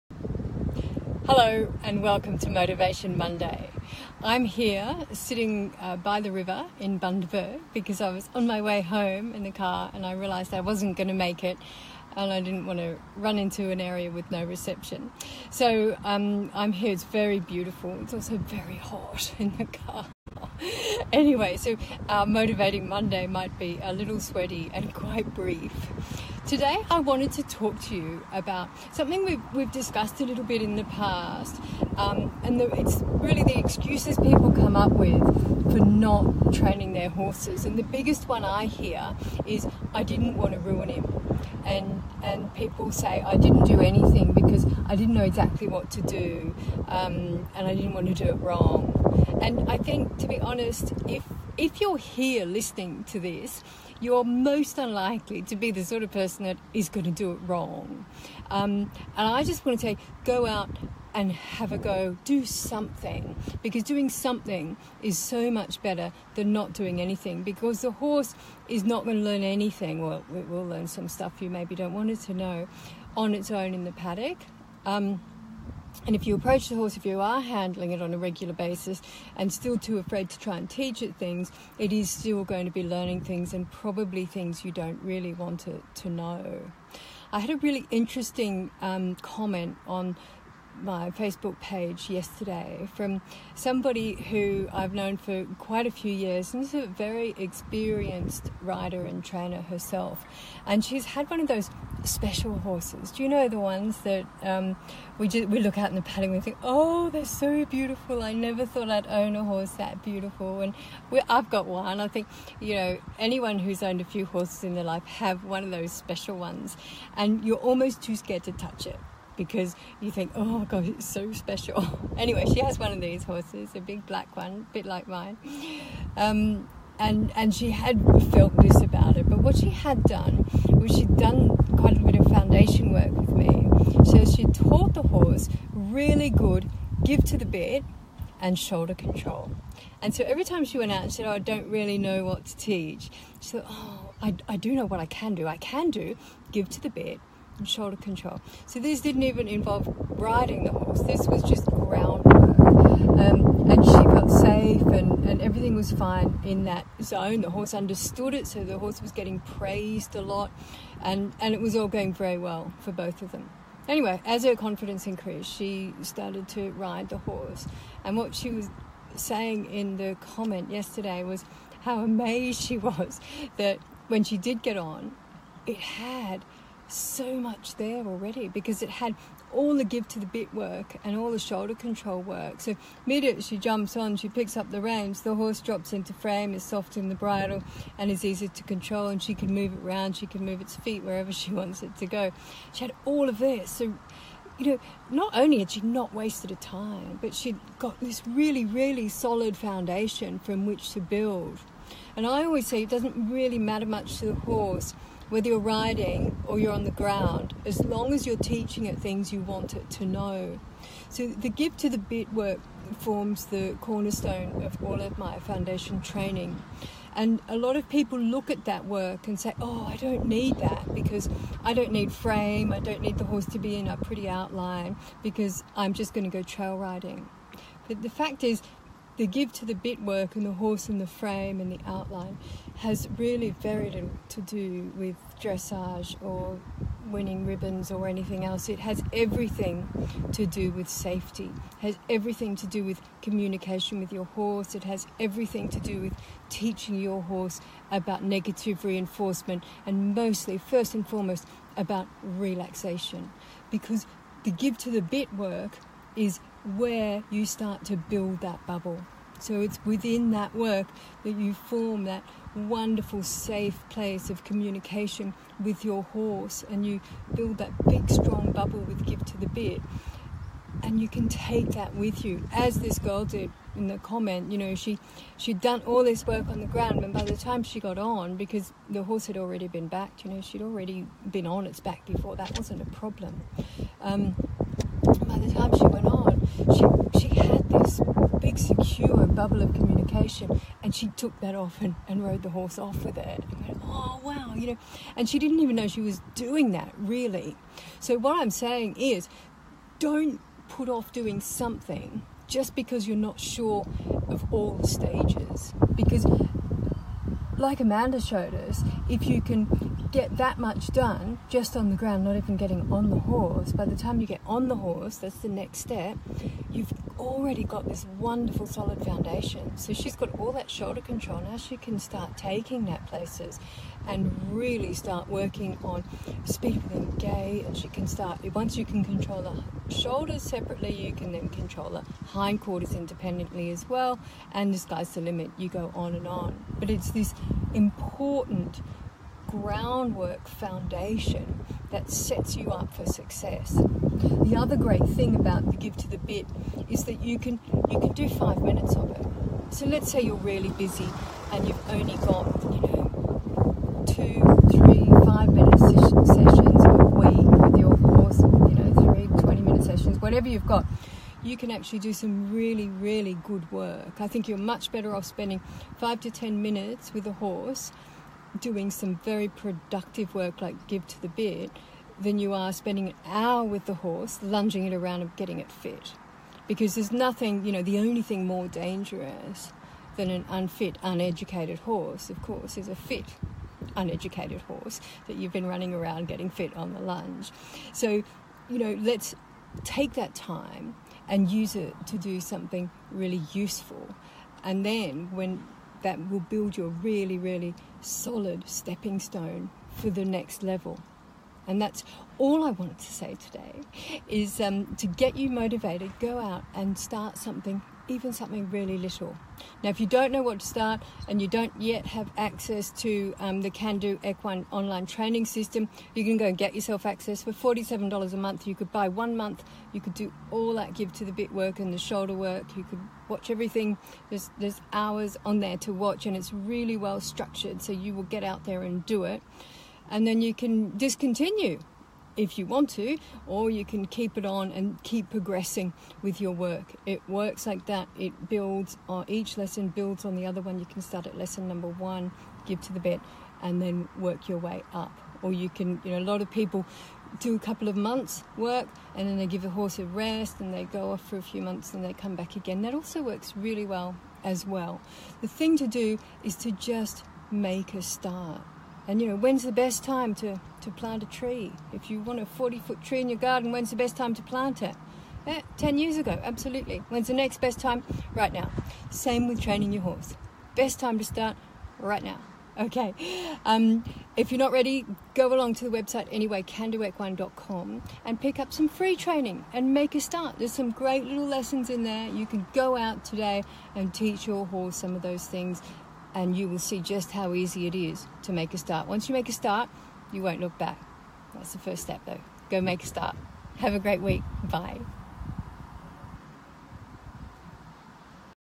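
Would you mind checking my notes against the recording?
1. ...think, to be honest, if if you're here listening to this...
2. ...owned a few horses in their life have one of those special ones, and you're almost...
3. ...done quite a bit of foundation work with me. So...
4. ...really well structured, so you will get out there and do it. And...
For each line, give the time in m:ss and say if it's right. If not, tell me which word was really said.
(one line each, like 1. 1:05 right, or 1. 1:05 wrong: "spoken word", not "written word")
1. 0:49 right
2. 1:53 right
3. 2:11 right
4. 7:06 right.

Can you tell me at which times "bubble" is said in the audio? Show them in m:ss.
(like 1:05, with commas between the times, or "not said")
4:18, 4:28, 4:49.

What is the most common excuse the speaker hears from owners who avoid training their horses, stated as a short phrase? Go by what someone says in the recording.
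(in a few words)
I didn't want to ruin him.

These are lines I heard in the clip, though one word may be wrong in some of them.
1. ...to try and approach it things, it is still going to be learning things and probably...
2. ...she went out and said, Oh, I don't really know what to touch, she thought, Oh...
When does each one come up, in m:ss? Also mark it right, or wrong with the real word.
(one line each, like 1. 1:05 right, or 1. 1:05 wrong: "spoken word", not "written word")
1. 1:20 wrong: "teach", not "approach"
2. 2:20 wrong: "teach", not "touch".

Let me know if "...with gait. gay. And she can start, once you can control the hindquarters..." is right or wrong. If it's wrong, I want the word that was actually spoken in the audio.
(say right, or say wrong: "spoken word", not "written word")
wrong: "shoulders", not "hindquarters".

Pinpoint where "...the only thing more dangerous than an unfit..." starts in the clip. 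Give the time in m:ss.
6:17.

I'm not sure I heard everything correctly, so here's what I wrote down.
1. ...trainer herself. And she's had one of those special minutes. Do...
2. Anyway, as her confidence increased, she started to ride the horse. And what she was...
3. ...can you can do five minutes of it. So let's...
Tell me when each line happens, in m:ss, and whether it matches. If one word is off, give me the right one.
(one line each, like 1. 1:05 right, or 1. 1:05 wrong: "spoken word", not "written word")
1. 1:39 wrong: "horses", not "minutes"
2. 2:43 right
3. 5:47 right.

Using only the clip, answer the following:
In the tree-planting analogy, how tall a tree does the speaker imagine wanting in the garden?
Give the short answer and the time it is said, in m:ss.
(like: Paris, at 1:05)
40 feet, at 7:42.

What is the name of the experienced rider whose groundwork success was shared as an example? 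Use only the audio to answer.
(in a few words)
Amanda.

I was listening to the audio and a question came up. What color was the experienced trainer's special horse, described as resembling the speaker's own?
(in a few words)
Black.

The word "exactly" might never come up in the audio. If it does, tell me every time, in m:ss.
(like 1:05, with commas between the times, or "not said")
0:45.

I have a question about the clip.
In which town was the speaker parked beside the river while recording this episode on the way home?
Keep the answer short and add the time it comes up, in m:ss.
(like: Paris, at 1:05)
Bundaberg, at 0:06.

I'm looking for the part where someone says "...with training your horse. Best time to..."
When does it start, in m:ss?
7:49.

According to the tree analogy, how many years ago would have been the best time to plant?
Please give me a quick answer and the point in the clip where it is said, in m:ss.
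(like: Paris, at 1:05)
10 years, at 7:45.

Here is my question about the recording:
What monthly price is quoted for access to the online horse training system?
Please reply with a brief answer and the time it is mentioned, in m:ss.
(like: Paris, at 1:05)
$47, at 6:57.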